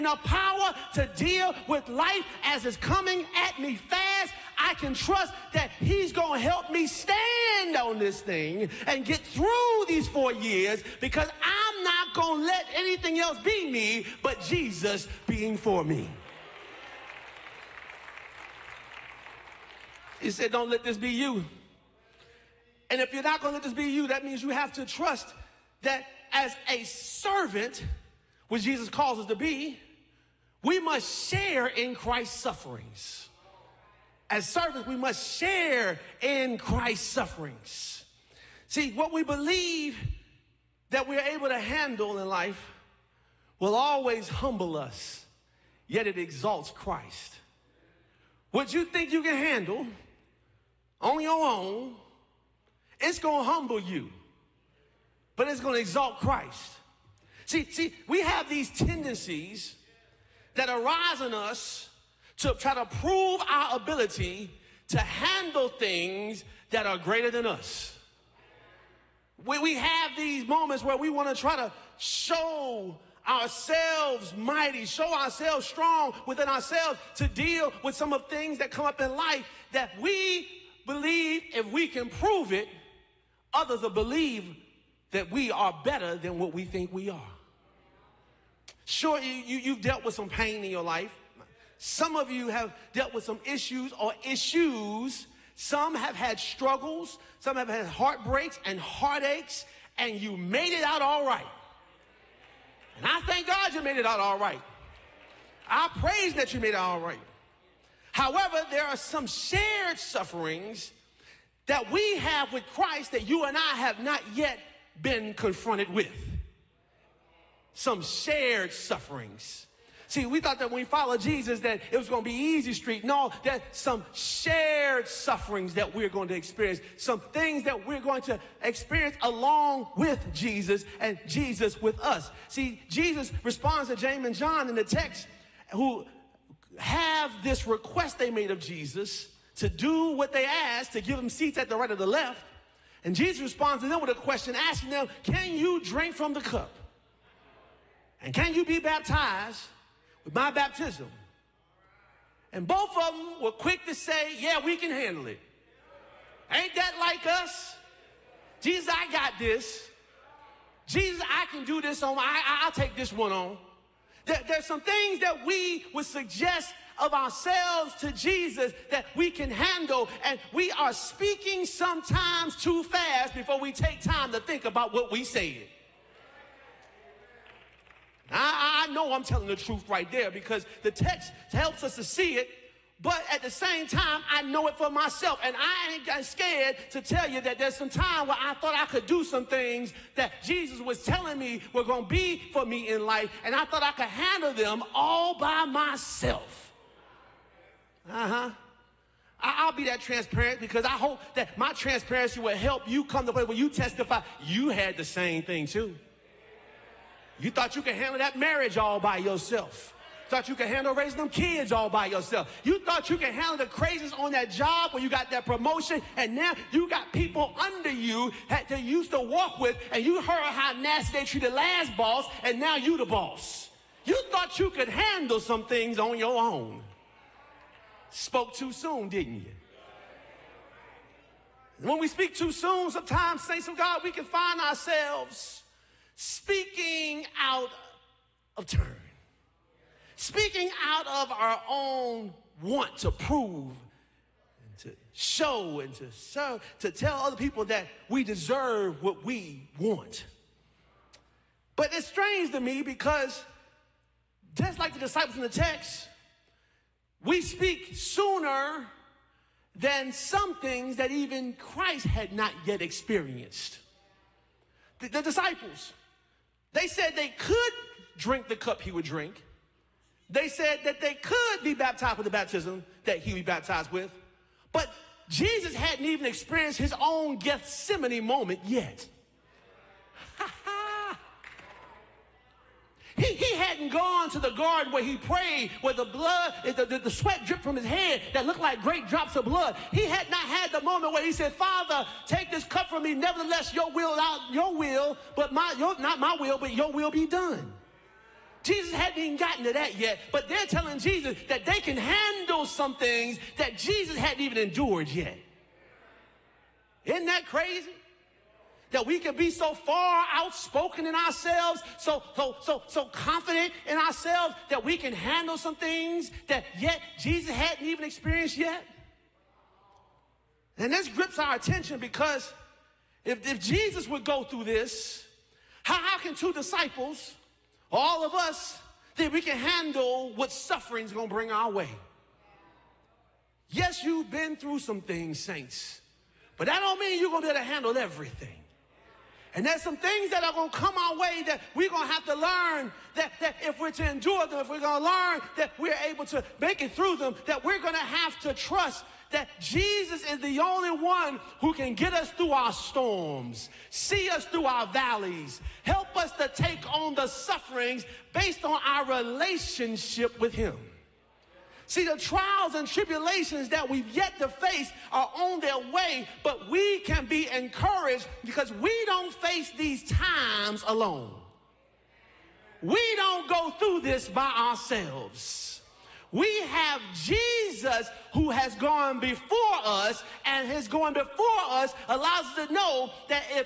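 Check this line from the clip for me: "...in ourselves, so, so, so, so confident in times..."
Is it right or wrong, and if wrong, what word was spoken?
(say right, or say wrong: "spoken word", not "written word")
wrong: "ourselves", not "times".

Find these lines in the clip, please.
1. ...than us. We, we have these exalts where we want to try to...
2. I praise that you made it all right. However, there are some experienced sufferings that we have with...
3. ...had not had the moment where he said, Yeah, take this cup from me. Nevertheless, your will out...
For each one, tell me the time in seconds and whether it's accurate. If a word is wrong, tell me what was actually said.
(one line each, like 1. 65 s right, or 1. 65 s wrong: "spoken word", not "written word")
1. 67 s wrong: "moments", not "exalts"
2. 105 s wrong: "shared", not "experienced"
3. 290 s wrong: "Father", not "Yeah".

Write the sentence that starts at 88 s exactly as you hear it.
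Sure, you, you, you've dealt with some pain in your life.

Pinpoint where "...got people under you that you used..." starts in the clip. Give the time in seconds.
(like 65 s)
216 s.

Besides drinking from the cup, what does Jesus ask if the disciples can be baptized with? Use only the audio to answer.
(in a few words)
my baptism.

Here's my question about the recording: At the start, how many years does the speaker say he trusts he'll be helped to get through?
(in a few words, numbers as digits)
4.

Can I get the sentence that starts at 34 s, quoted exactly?
As servants, we must share in Christ's sufferings.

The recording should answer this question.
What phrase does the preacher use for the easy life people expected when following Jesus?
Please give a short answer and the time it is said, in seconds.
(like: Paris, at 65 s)
easy street, at 122 s.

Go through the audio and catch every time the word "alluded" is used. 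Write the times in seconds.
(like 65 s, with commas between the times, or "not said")
not said.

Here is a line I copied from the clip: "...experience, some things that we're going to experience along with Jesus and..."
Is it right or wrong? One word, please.
right.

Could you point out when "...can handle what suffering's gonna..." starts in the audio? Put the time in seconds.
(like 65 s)
329 s.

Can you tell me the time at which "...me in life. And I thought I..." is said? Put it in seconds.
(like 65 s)
192 s.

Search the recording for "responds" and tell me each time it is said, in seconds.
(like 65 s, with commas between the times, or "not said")
133 s, 143 s.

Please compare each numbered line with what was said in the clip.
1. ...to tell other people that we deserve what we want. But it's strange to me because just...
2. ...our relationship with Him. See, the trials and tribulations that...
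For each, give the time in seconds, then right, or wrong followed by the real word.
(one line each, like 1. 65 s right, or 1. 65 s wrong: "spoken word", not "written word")
1. 246 s right
2. 358 s right.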